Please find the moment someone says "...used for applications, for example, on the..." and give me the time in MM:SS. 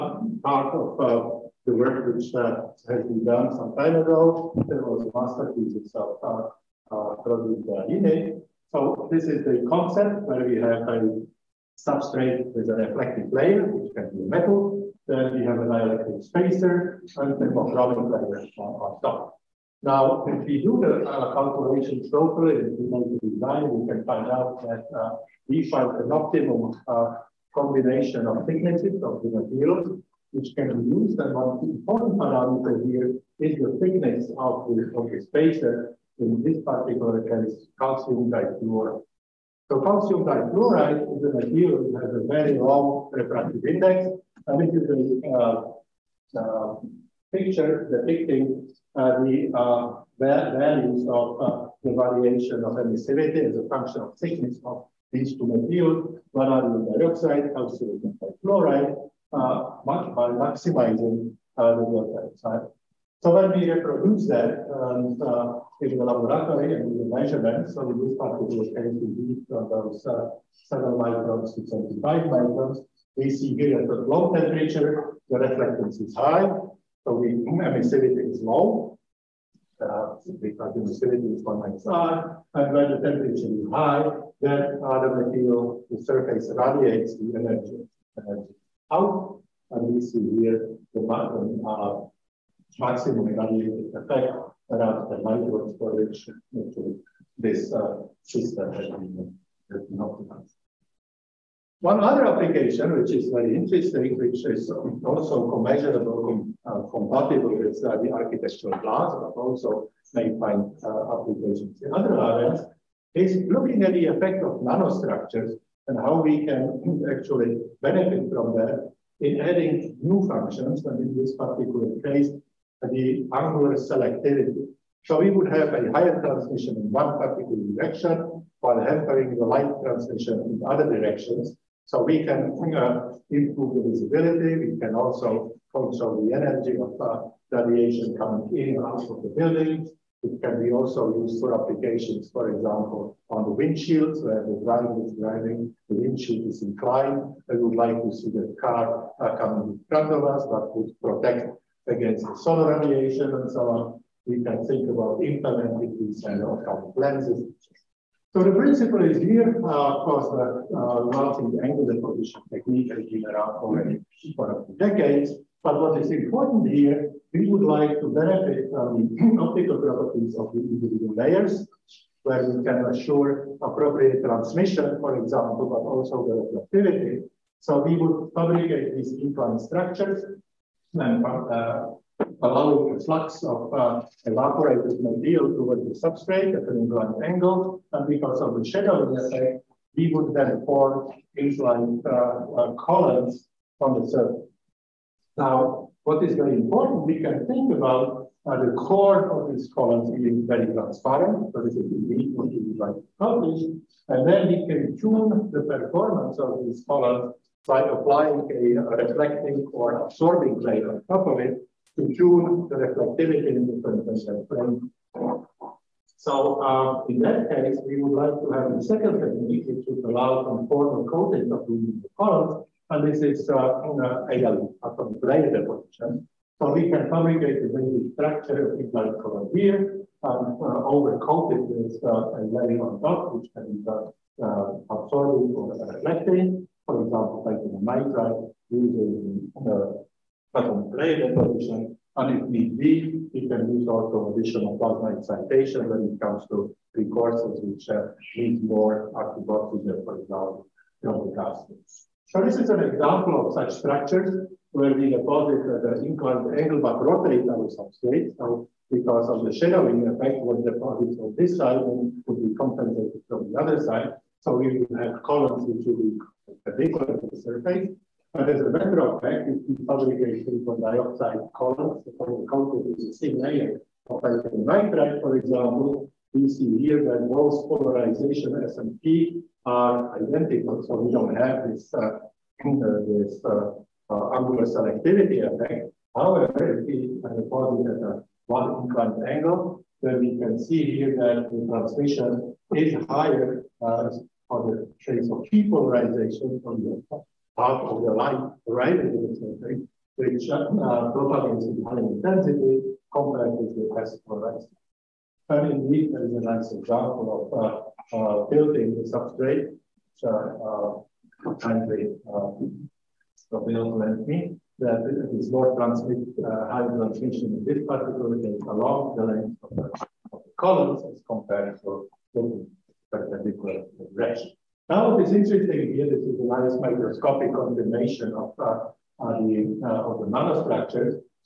02:21.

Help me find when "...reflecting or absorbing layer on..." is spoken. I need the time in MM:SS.
03:29.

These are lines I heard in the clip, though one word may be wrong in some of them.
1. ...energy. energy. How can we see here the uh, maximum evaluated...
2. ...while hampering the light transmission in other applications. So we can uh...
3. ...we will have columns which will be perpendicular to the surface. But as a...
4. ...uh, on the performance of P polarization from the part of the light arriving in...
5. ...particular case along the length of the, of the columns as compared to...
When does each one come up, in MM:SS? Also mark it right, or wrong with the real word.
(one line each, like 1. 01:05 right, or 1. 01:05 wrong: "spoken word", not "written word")
1. 01:27 right
2. 02:08 wrong: "directions", not "applications"
3. 04:24 right
4. 04:53 wrong: "trace", not "performance"
5. 05:17 right.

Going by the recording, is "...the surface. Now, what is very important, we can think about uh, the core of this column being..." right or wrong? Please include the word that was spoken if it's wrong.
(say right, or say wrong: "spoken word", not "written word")
right.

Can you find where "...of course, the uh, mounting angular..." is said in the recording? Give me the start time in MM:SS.
02:39.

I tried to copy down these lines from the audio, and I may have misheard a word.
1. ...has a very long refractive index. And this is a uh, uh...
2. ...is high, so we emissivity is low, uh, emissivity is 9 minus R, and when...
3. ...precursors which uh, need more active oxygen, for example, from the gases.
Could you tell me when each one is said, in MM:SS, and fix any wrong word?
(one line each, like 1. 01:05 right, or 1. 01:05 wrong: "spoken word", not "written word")
1. 00:42 right
2. 01:16 wrong: "1", not "9"
3. 04:06 right.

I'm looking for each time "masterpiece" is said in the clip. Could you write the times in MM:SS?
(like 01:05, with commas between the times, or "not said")
00:05.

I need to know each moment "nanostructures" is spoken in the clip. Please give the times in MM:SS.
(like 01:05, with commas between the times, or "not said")
01:54, 05:30.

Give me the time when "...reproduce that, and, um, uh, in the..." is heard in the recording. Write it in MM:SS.
01:03.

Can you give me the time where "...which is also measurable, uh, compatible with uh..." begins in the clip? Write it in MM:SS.
01:44.